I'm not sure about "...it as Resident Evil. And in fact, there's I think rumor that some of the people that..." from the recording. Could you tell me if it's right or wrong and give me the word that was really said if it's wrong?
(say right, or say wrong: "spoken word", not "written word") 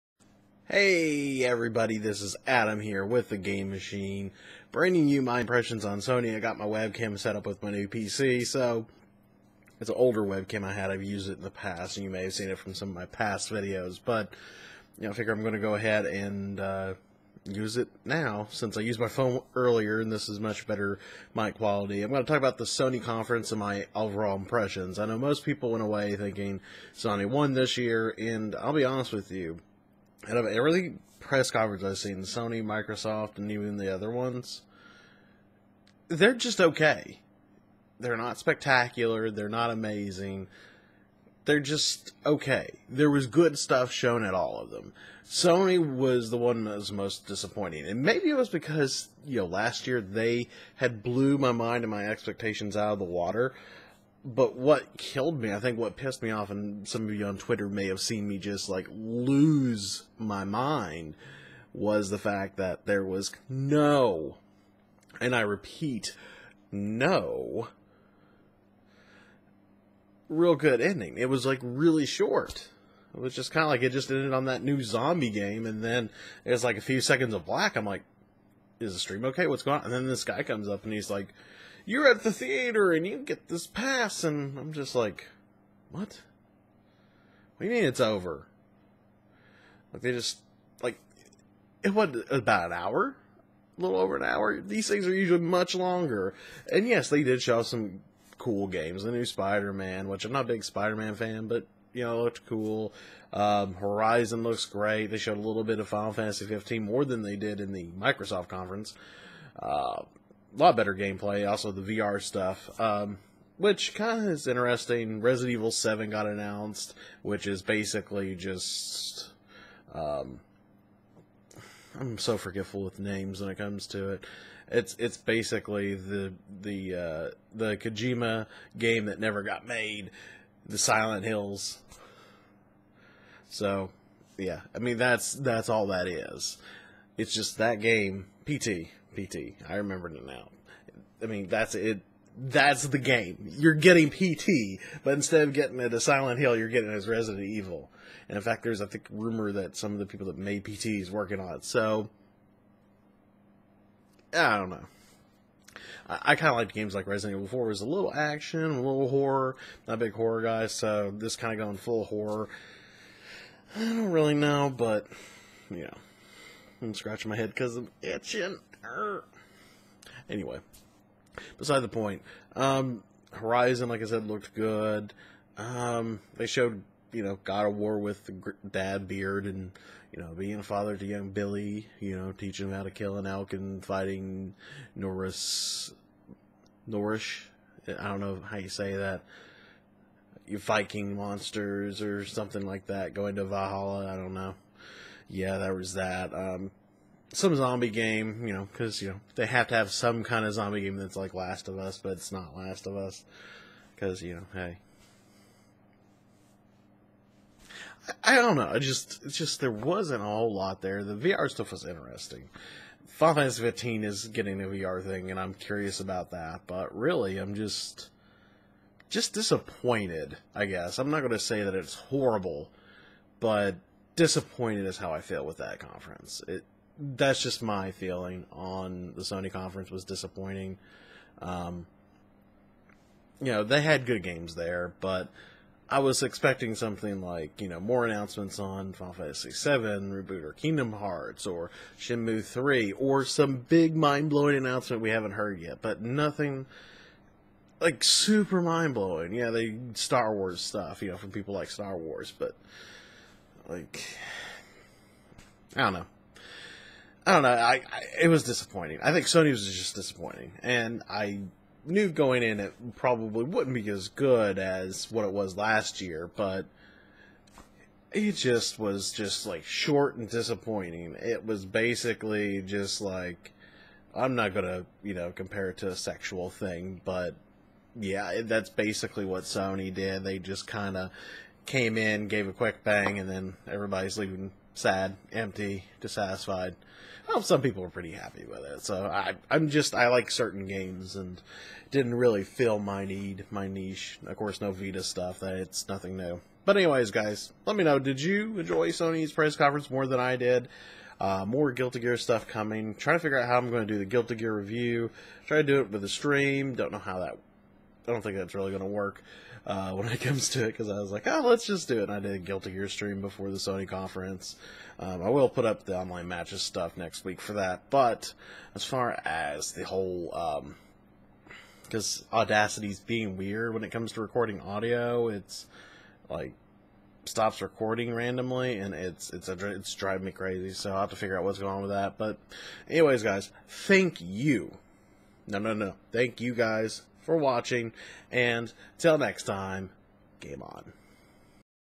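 right.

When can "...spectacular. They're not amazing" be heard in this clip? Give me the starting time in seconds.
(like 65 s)
38 s.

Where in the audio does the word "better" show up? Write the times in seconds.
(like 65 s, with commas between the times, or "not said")
20 s, 110 s.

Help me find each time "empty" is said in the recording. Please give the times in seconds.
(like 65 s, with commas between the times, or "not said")
285 s.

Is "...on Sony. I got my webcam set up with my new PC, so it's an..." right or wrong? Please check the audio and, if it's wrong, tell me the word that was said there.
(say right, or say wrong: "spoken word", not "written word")
right.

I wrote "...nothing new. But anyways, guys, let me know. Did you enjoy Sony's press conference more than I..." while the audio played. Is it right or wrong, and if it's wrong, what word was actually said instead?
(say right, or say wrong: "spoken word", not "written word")
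right.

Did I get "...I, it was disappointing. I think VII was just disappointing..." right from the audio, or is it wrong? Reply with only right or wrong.
wrong.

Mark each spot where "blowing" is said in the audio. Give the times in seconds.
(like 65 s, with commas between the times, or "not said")
243 s, 248 s.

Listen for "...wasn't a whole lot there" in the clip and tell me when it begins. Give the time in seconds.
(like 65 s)
209 s.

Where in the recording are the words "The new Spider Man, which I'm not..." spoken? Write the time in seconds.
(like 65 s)
99 s.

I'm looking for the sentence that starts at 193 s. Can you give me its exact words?
Going to Valhalla, I don't know.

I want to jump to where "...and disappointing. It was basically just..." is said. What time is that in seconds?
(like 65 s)
270 s.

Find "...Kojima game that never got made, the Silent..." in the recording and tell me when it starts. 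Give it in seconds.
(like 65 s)
127 s.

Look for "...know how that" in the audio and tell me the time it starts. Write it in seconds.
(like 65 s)
306 s.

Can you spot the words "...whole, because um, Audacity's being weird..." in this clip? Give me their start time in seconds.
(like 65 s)
319 s.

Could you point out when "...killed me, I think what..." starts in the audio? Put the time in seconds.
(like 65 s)
54 s.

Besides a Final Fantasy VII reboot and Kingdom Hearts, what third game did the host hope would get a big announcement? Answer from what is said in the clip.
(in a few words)
Shenmue 3.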